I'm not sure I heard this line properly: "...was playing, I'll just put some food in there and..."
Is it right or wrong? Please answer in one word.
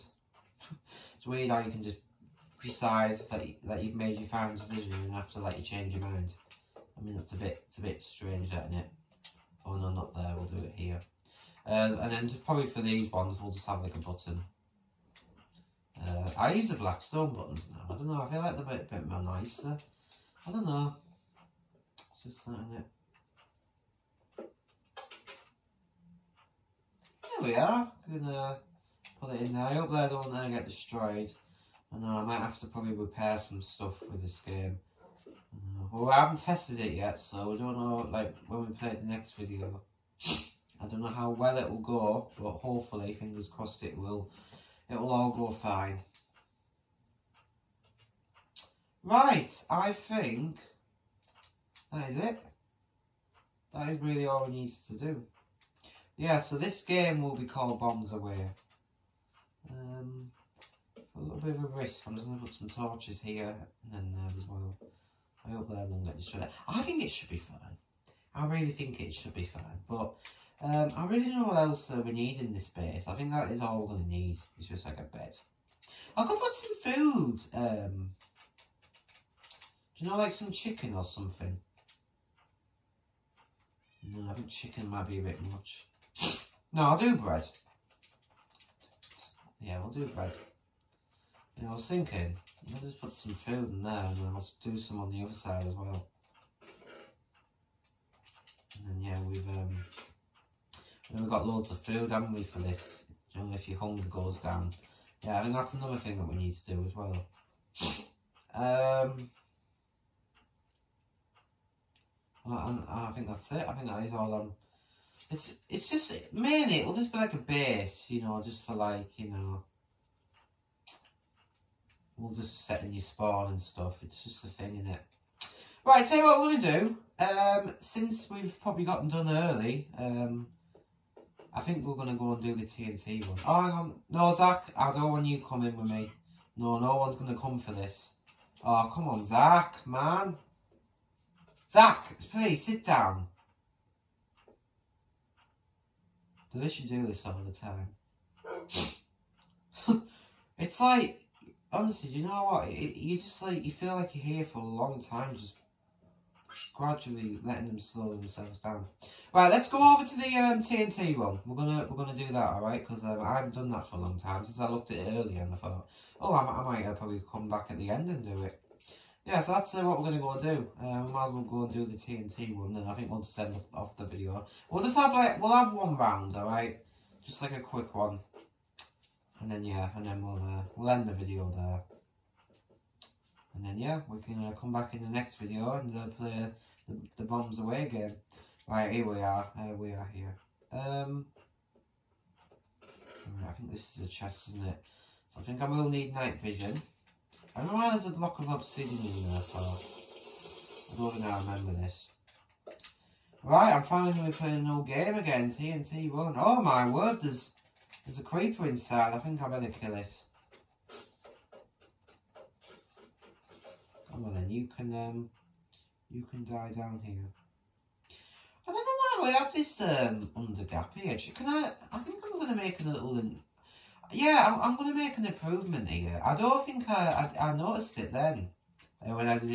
wrong.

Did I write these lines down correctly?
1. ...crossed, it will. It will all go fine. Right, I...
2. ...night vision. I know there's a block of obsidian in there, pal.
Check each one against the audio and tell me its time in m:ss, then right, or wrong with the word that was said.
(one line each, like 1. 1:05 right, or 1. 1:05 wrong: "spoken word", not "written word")
1. 0:43 right
2. 3:16 right.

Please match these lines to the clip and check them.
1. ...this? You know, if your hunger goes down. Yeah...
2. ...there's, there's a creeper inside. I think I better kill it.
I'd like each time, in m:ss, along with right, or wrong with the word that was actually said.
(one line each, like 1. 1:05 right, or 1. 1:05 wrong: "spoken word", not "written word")
1. 1:42 right
2. 3:27 right.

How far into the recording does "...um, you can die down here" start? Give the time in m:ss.
3:34.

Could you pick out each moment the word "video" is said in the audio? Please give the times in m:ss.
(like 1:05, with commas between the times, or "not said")
0:39, 2:54, 3:01, 3:05.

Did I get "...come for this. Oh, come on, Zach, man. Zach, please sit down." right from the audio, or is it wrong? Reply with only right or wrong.
right.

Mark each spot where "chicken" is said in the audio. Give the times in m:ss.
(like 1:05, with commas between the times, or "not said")
1:20, 1:24.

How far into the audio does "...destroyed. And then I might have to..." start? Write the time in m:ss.
0:30.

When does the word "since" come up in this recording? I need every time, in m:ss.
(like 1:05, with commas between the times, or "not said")
2:07, 2:44.